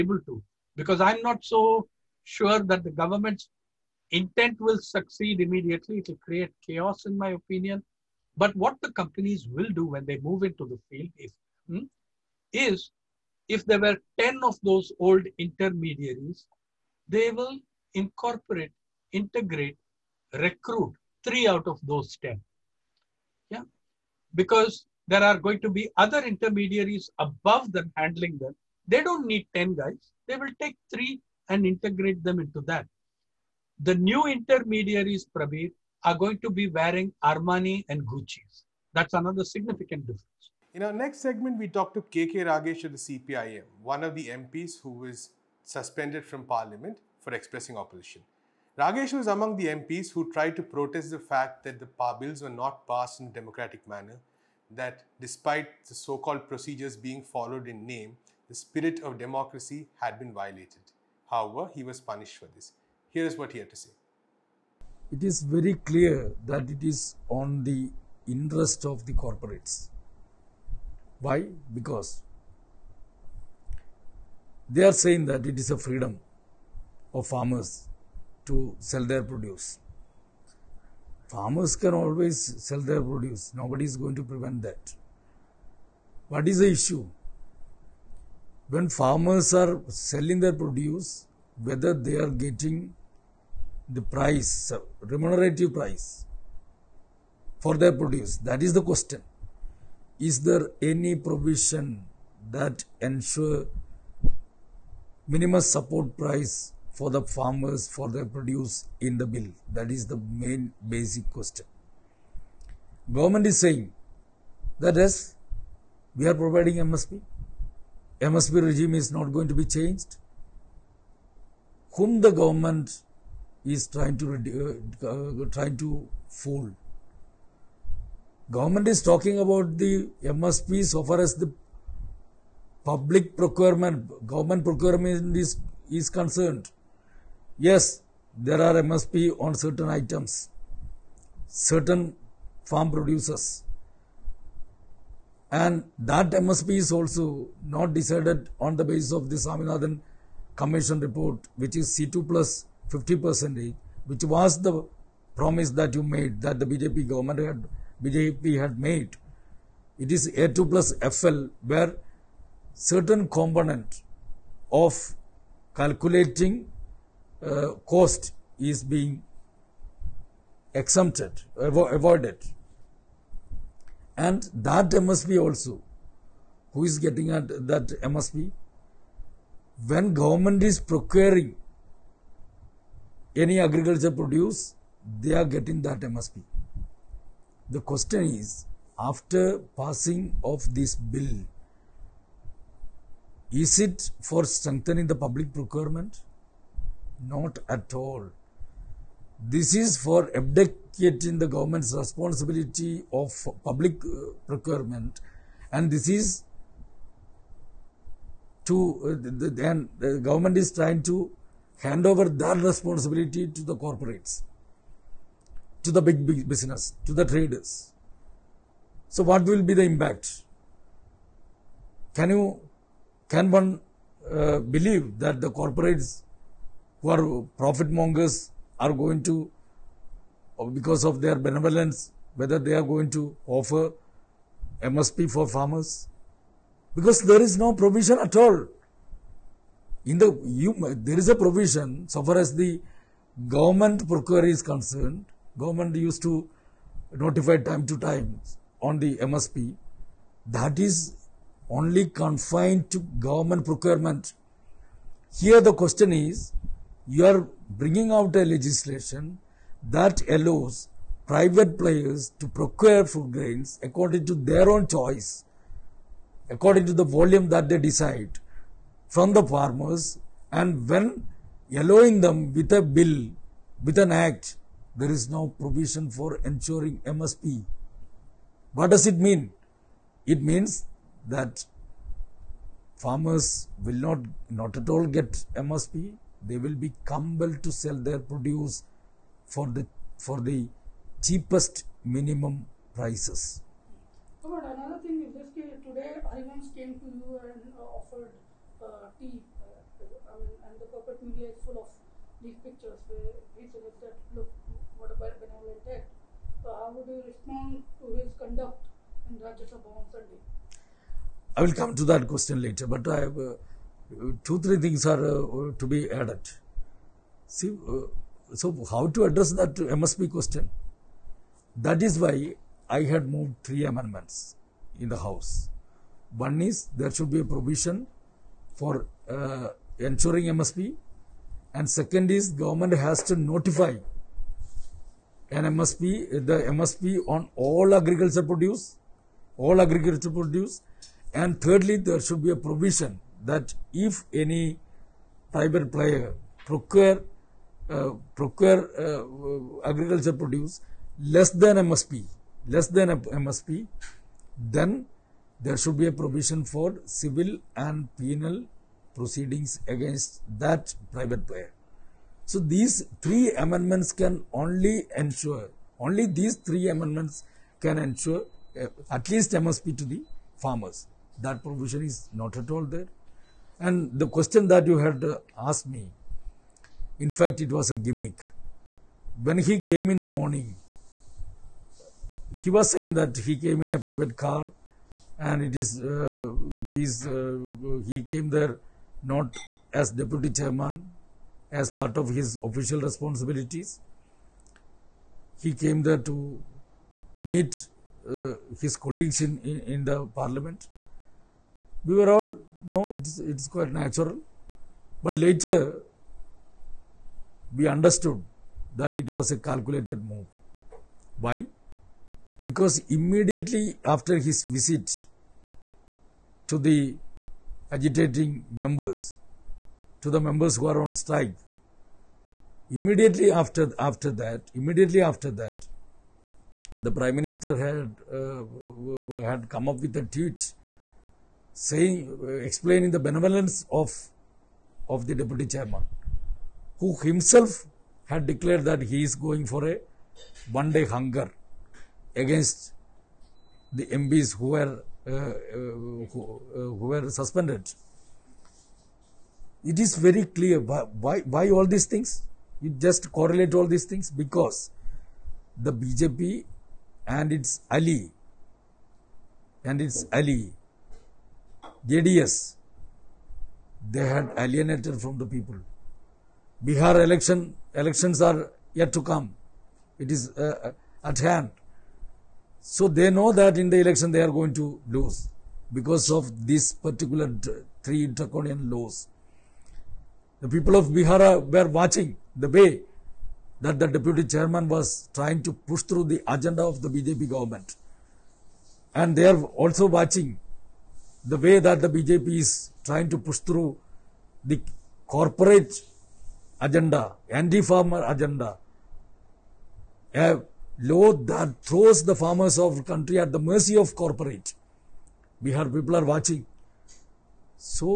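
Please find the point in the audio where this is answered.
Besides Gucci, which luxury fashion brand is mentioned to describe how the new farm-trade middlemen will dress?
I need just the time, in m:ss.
0:37.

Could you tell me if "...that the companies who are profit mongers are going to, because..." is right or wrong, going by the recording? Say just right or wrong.
wrong.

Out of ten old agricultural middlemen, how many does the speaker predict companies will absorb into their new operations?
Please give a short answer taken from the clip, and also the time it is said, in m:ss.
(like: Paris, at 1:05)
3, at 0:21.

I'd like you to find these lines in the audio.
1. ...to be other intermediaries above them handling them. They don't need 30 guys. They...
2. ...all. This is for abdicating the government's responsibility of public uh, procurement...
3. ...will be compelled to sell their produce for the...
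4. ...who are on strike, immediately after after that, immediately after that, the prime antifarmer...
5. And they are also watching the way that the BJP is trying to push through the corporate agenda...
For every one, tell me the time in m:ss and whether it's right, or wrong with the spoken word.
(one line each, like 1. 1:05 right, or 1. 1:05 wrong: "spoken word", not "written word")
1. 0:25 wrong: "10", not "30"
2. 3:17 right
3. 4:46 right
4. 7:00 wrong: "minister", not "antifarmer"
5. 8:09 right.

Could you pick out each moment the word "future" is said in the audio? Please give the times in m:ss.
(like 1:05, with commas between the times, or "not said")
not said.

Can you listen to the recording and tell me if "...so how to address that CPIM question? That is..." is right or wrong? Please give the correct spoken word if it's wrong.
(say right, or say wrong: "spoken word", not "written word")
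wrong: "MSP", not "CPIM".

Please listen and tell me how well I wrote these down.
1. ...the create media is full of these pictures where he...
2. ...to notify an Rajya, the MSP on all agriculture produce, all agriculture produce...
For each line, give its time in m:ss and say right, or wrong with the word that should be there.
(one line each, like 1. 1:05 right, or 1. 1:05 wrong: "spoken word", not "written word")
1. 5:00 wrong: "corporate", not "create"
2. 5:33 wrong: "MSP", not "Rajya".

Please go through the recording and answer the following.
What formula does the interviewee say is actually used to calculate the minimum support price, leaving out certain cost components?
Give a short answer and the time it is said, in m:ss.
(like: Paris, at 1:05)
A2 plus FL, at 2:40.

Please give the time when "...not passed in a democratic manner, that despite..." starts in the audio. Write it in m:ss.
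0:52.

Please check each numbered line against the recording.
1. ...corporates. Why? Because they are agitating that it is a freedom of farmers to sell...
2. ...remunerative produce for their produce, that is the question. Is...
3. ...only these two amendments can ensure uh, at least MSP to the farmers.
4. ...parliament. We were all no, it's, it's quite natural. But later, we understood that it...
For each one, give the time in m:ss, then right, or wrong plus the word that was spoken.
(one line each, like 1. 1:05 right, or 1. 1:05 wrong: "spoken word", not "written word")
1. 1:09 wrong: "saying", not "agitating"
2. 1:35 wrong: "price", not "produce"
3. 6:06 wrong: "three", not "two"
4. 6:40 right.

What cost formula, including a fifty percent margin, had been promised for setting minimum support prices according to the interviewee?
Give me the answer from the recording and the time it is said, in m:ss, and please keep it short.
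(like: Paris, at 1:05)
C2 plus 50 percent, at 2:31.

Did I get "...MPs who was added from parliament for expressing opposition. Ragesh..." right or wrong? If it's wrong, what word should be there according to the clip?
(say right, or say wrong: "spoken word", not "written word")
wrong: "suspended", not "added".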